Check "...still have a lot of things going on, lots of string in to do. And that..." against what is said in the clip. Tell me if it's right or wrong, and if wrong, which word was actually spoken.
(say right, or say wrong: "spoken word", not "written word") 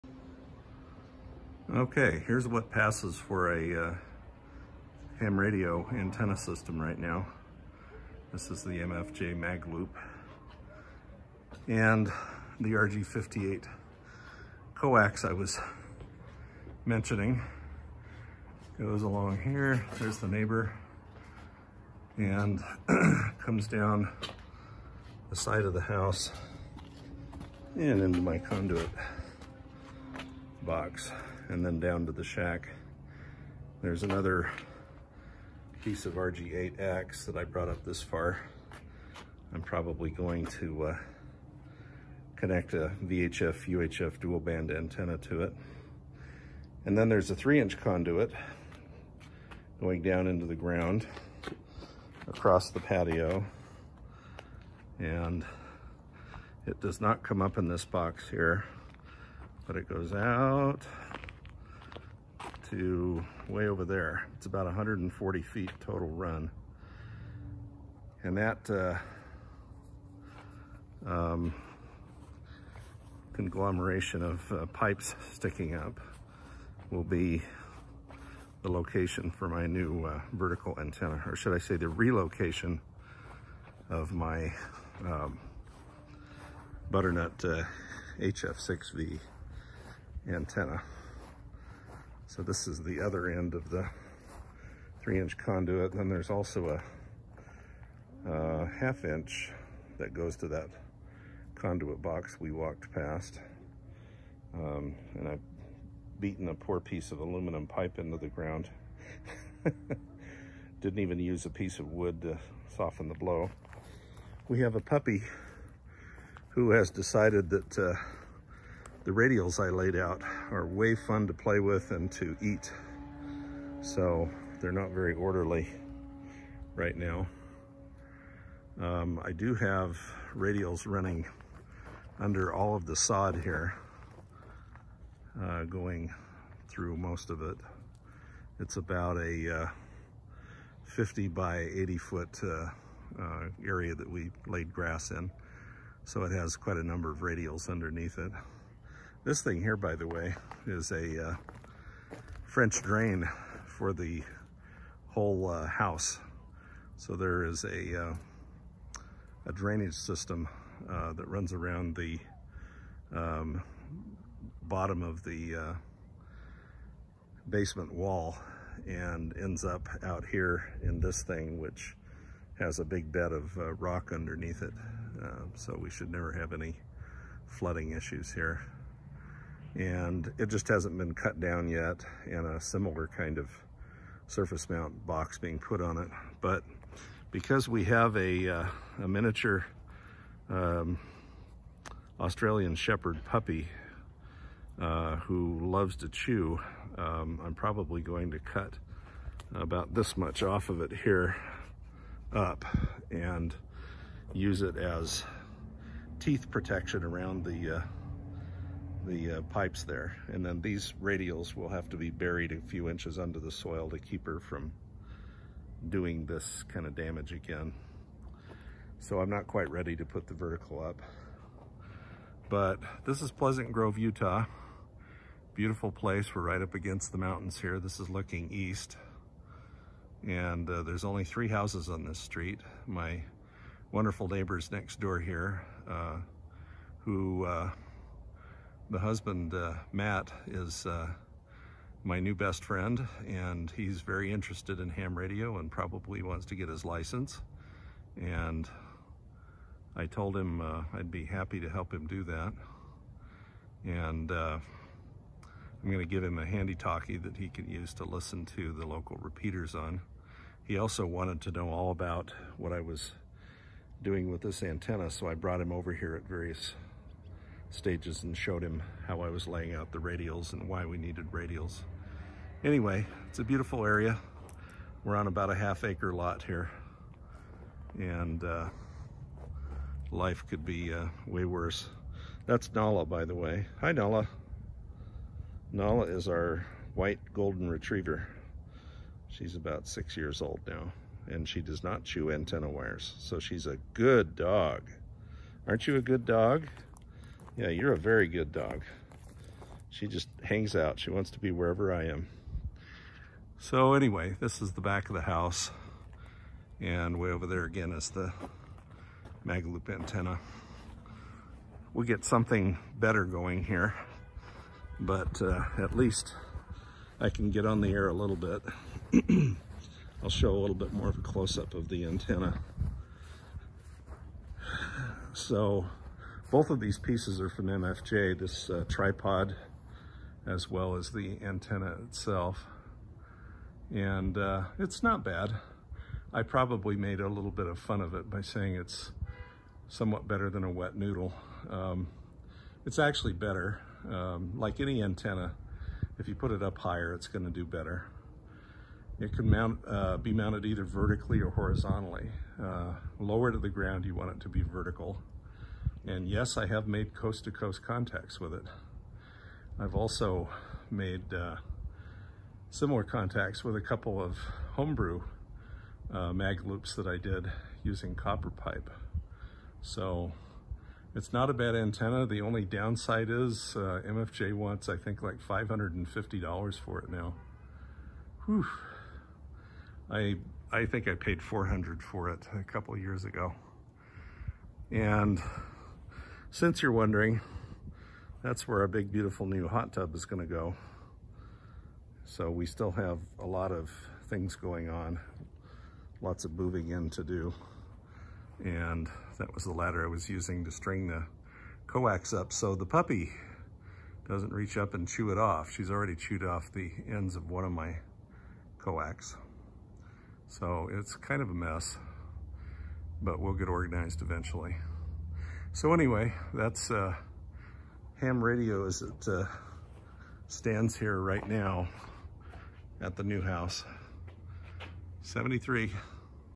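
wrong: "moving", not "string".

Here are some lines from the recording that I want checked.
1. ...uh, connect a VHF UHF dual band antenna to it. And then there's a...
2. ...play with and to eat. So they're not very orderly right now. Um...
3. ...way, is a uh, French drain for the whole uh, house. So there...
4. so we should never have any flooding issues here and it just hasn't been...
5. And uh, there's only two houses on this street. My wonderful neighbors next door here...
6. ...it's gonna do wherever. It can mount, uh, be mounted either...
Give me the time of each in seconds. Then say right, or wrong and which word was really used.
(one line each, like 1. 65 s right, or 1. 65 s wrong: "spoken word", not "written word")
1. 40 s right
2. 121 s right
3. 150 s right
4. 175 s right
5. 230 s wrong: "three", not "two"
6. 347 s wrong: "better", not "wherever".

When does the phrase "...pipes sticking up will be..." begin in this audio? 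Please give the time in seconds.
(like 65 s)
74 s.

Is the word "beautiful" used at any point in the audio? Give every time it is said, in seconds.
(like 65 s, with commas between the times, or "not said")
225 s, 273 s, 389 s.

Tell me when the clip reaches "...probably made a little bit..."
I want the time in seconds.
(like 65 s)
336 s.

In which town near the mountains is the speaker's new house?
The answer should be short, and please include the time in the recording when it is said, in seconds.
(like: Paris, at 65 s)
Pleasant Grove, Utah, at 223 s.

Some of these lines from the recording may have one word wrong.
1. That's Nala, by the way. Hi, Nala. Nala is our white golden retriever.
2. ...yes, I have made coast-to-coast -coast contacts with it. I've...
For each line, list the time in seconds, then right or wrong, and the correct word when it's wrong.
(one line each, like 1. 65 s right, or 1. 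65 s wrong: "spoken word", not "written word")
1. 282 s right
2. 356 s right.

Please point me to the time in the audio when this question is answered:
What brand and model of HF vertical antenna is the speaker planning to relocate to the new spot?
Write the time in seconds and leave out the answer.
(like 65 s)
86 s.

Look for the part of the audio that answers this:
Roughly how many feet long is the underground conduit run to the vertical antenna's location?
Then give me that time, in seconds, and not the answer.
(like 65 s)
64 s.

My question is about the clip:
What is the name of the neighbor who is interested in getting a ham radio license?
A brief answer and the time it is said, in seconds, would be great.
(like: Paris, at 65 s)
Matt, at 239 s.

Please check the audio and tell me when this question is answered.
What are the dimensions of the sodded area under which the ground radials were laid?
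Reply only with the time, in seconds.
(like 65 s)
140 s.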